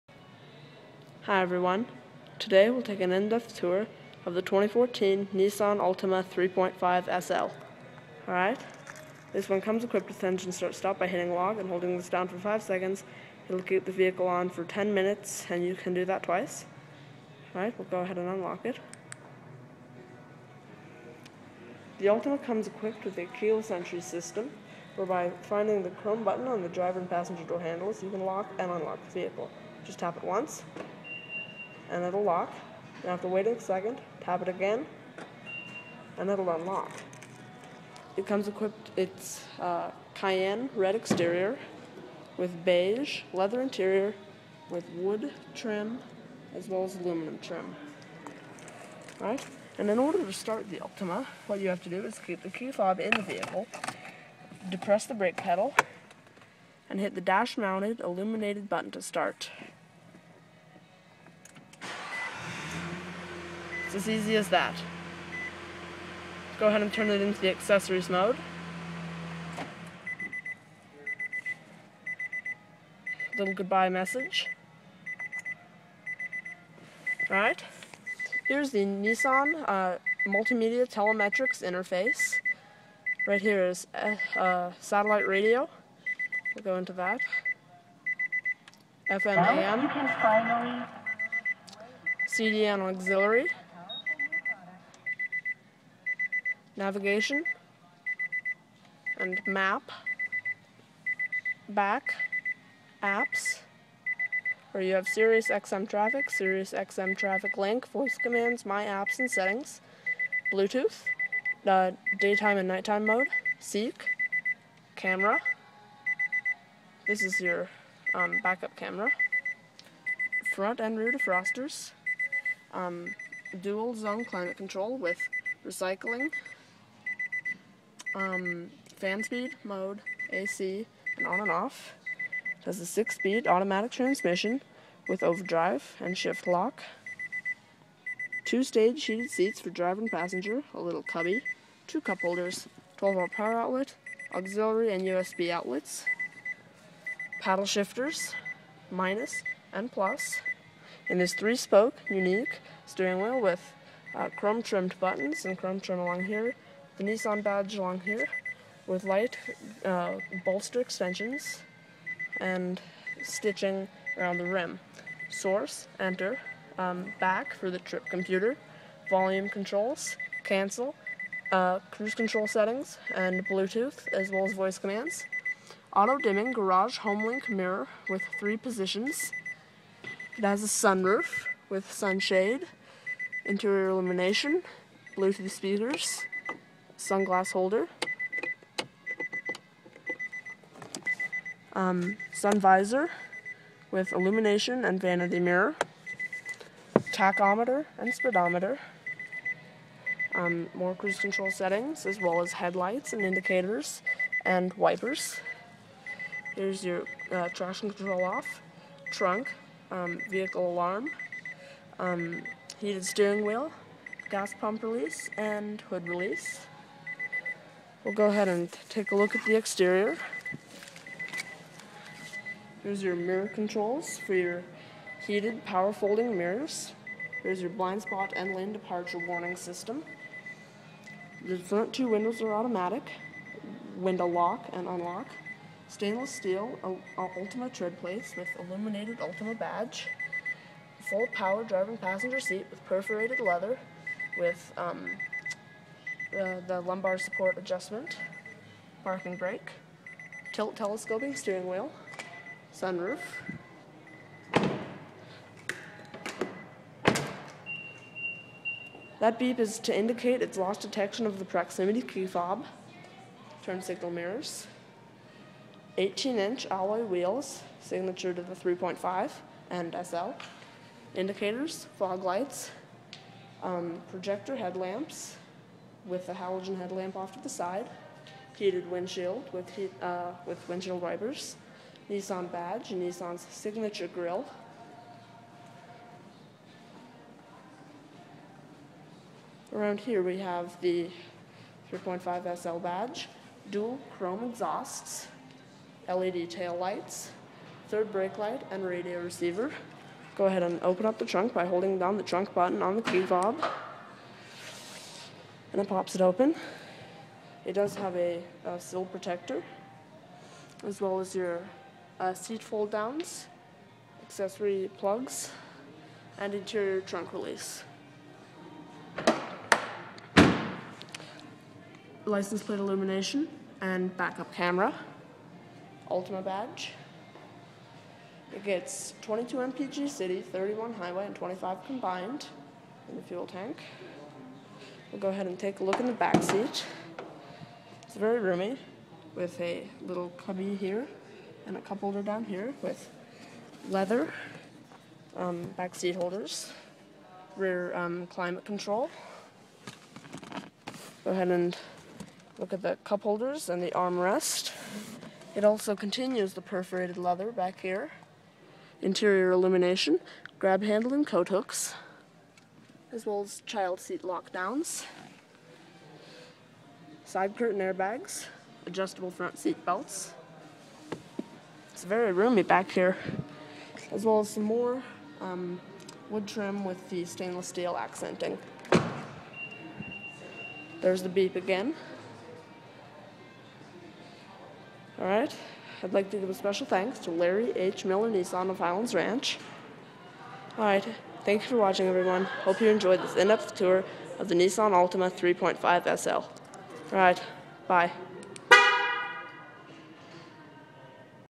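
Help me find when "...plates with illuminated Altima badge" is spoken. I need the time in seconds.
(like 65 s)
237 s.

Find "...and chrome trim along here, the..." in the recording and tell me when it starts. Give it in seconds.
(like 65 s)
155 s.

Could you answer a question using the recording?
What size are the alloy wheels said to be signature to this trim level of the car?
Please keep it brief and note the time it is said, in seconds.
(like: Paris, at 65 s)
18 inch, at 265 s.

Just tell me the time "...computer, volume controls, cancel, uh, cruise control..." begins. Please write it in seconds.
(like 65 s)
168 s.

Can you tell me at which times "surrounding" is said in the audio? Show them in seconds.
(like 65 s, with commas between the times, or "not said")
not said.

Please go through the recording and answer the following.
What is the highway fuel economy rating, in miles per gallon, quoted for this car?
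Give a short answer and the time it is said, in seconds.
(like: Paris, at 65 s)
31, at 330 s.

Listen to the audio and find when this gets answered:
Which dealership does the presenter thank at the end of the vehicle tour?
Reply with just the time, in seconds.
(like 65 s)
387 s.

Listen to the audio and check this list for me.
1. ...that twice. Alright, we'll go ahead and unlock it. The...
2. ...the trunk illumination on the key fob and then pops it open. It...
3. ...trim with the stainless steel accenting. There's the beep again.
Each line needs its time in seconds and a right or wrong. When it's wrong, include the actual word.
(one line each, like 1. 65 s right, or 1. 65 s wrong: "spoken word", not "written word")
1. 16 s right
2. 302 s wrong: "button", not "illumination"
3. 376 s right.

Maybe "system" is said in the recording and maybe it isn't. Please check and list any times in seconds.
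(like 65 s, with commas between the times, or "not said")
24 s, 229 s.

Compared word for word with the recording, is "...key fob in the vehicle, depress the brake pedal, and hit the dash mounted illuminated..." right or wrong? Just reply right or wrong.
right.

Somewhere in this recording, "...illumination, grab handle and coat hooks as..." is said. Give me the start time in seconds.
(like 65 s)
359 s.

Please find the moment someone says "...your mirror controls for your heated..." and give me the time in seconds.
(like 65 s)
223 s.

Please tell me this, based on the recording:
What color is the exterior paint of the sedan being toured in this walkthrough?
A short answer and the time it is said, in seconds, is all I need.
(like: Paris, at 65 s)
Cayenne red, at 40 s.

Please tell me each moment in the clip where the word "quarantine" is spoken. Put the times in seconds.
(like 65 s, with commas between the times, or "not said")
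not said.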